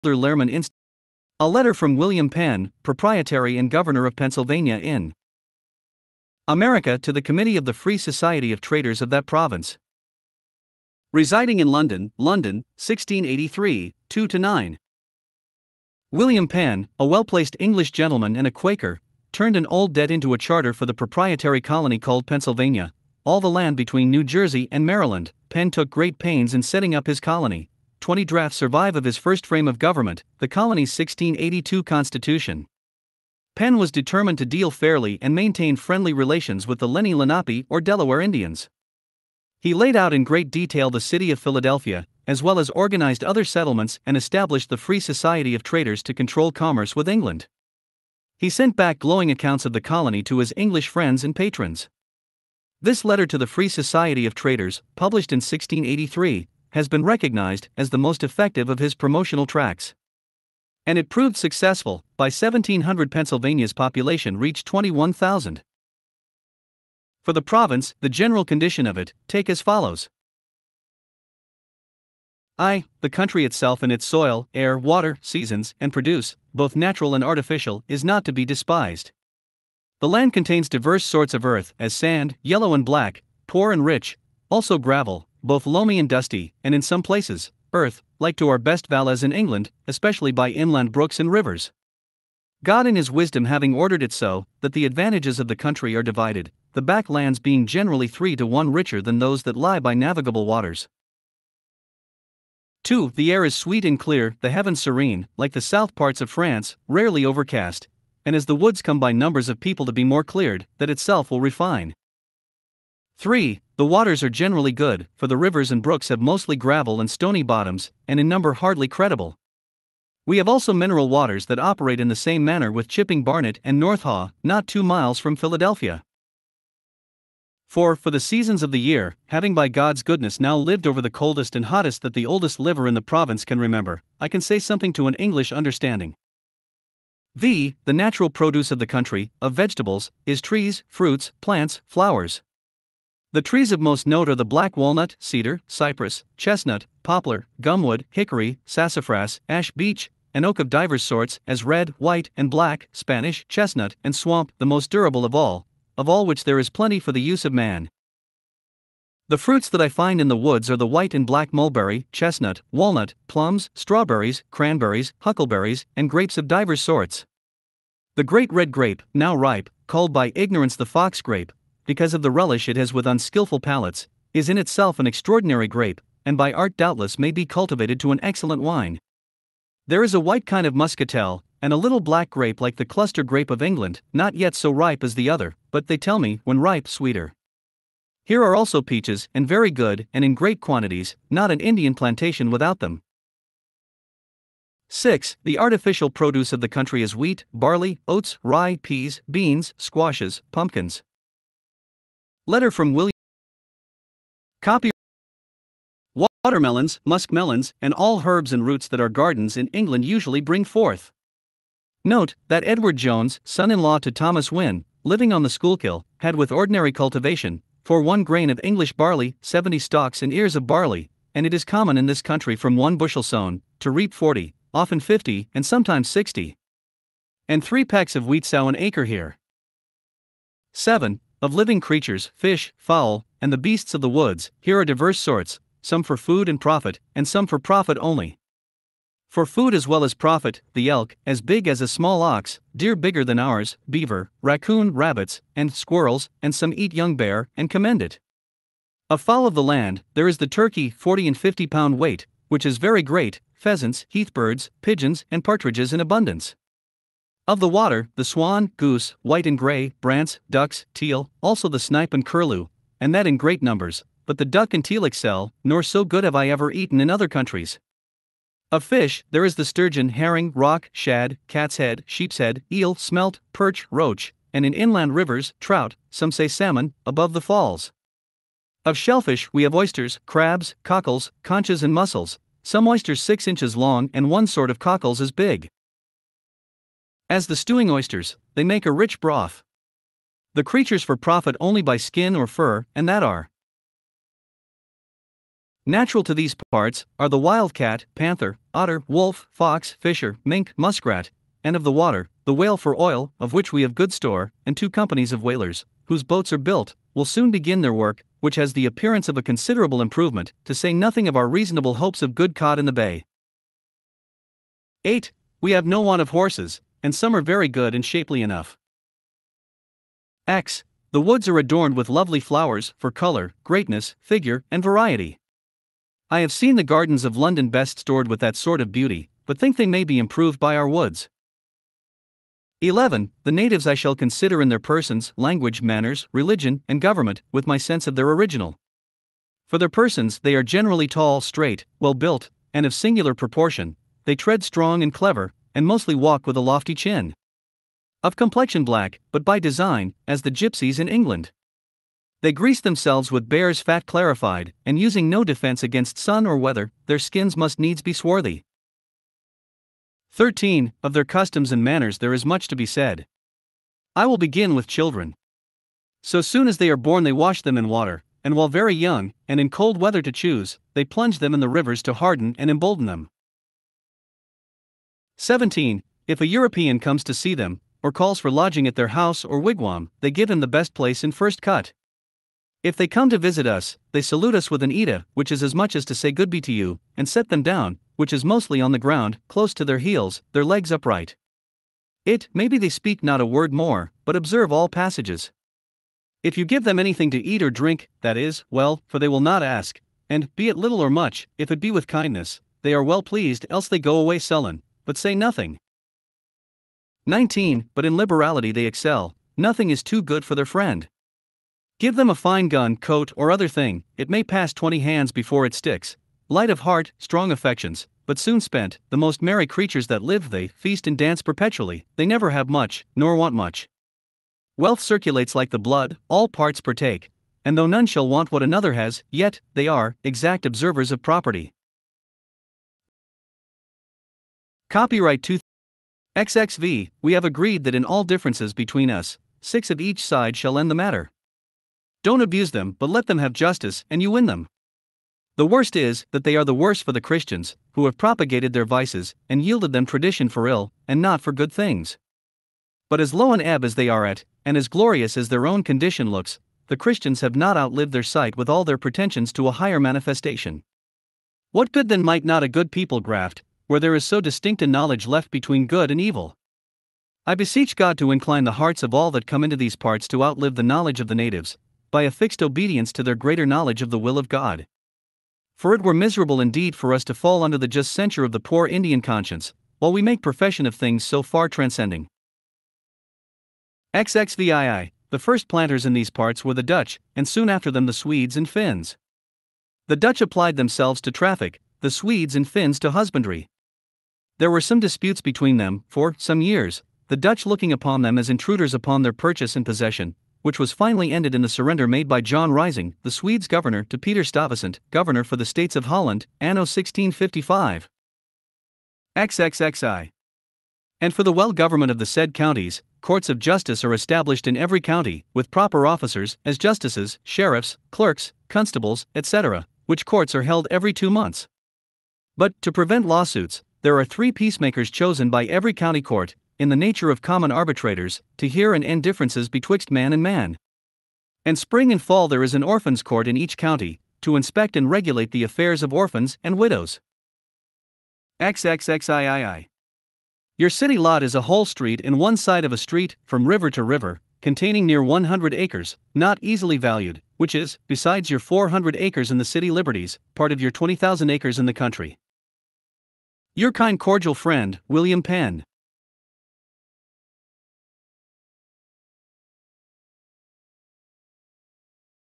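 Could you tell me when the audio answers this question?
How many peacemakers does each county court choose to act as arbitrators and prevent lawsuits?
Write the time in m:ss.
8:44.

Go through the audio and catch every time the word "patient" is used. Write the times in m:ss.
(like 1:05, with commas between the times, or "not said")
not said.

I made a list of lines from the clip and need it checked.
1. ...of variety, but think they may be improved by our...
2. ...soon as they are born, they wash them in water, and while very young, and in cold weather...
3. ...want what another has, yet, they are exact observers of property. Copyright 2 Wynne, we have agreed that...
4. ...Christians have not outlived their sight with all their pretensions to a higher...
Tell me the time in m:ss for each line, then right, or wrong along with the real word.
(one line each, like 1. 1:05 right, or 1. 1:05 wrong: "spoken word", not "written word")
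1. 5:28 wrong: "beauty", not "variety"
2. 6:06 right
3. 7:08 wrong: "XXV", not "Wynne"
4. 7:36 right.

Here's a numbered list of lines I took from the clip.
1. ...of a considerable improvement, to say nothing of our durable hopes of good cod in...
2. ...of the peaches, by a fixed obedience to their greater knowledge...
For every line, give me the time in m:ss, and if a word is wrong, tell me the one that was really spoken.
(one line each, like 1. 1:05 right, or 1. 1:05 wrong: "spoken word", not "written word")
1. 5:09 wrong: "reasonable", not "durable"
2. 7:51 wrong: "natives", not "peaches".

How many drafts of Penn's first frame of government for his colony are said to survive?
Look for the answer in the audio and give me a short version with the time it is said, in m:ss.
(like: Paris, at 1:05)
20, at 0:28.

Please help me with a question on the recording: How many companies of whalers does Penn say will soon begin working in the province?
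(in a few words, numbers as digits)
2.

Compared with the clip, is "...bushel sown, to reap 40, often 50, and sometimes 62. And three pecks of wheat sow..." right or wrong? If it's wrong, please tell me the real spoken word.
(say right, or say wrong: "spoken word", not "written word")
wrong: "60", not "62".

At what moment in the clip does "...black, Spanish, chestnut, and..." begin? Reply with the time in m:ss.
2:32.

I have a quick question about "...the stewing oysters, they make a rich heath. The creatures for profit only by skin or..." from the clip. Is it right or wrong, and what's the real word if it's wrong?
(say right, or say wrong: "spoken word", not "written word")
wrong: "broth", not "heath".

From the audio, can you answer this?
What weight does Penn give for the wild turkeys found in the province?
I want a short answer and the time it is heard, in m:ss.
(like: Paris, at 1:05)
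40 and 50 pounds, at 4:10.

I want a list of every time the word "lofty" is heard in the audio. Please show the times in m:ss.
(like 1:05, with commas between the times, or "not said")
5:46.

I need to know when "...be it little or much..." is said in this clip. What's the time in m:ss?
6:40.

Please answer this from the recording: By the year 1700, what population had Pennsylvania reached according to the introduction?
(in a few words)
21,000.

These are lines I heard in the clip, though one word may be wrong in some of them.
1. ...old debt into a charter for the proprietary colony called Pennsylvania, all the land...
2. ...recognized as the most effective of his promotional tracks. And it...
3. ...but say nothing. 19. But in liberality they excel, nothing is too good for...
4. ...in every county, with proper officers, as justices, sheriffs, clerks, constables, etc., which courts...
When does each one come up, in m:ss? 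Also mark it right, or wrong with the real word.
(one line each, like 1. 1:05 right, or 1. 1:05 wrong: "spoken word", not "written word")
1. 0:19 right
2. 0:57 right
3. 6:45 right
4. 8:34 right.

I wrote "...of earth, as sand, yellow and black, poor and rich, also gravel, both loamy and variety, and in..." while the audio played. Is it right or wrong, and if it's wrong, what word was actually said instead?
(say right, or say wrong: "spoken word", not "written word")
wrong: "dusty", not "variety".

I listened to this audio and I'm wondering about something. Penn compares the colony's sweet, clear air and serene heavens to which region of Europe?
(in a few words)
the south parts of France.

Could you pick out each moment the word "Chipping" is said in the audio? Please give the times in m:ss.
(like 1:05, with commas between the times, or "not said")
2:02.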